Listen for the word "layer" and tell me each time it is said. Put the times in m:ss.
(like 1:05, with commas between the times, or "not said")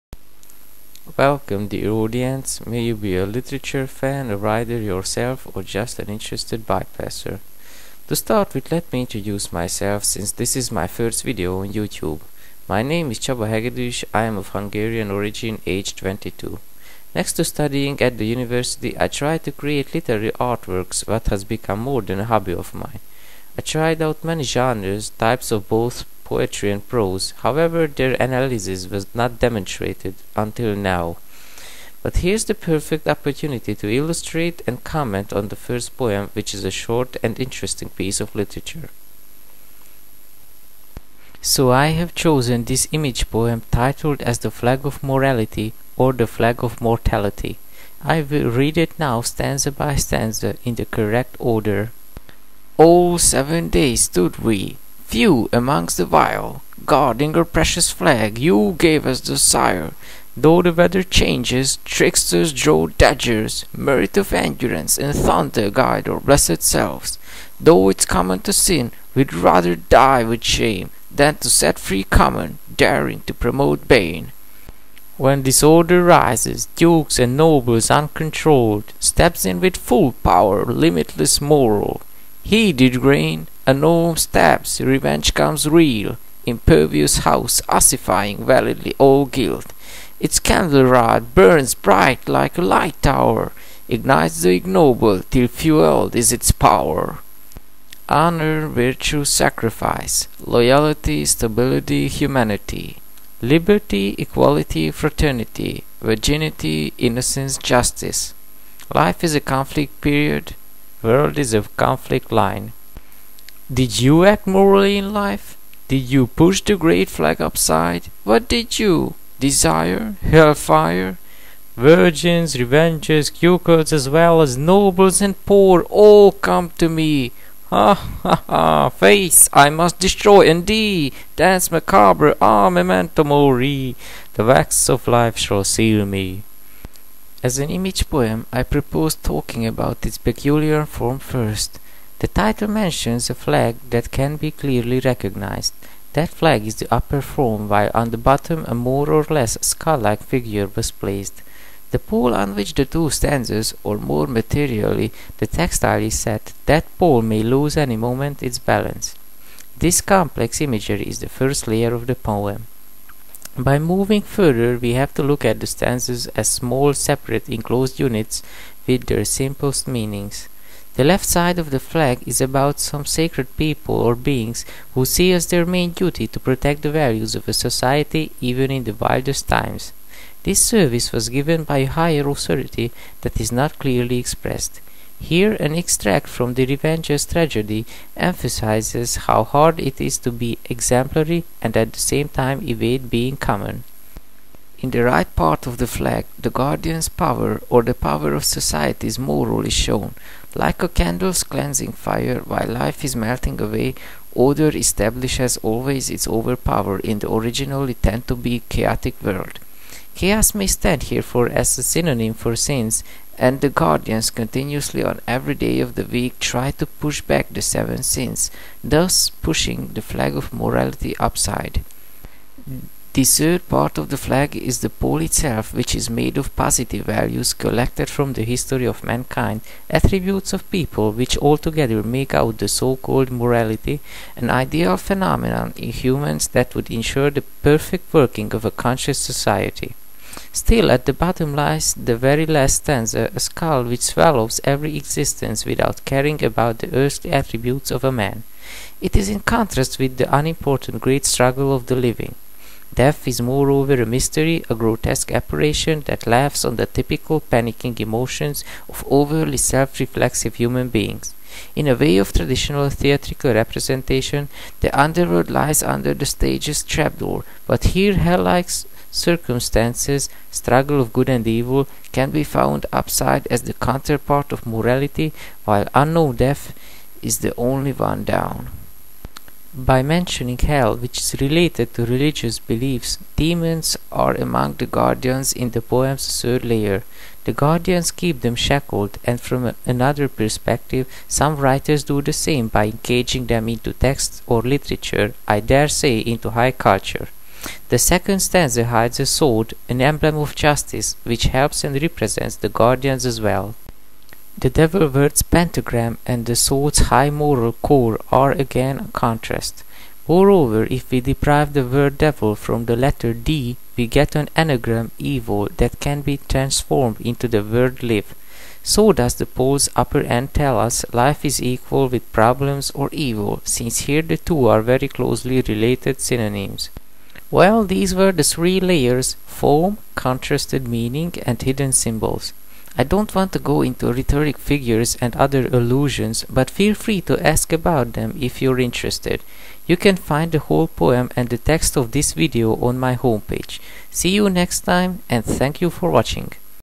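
2:41, 4:46, 5:28.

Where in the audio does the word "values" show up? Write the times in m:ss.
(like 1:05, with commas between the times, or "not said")
2:56, 3:47.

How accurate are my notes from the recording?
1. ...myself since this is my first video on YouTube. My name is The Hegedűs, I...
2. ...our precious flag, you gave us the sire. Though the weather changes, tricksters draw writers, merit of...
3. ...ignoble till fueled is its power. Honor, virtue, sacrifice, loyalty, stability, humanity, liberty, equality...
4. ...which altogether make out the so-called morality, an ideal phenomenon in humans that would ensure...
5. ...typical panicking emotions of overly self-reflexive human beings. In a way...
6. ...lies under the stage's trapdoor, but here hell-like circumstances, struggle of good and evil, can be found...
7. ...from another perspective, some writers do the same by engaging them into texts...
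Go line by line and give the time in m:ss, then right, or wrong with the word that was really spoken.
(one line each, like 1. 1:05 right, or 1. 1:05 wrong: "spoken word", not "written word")
1. 0:09 wrong: "Csaba", not "The"
2. 0:57 wrong: "daggers", not "writers"
3. 1:34 right
4. 3:51 right
5. 4:16 right
6. 4:25 right
7. 4:49 right.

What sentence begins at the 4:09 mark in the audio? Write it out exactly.
It is in contrast with the unimportant great struggle of the living.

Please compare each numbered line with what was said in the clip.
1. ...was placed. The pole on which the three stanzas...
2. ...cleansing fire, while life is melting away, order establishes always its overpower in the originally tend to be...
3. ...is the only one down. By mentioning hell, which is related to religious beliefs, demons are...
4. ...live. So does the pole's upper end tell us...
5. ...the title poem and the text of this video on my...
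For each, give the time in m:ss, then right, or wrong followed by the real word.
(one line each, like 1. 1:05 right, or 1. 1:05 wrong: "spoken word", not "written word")
1. 2:30 wrong: "two", not "three"
2. 3:21 right
3. 4:37 right
4. 5:18 right
5. 5:40 wrong: "whole", not "title".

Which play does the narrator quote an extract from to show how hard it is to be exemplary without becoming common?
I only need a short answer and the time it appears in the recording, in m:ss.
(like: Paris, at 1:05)
The Revenger's Tragedy, at 3:06.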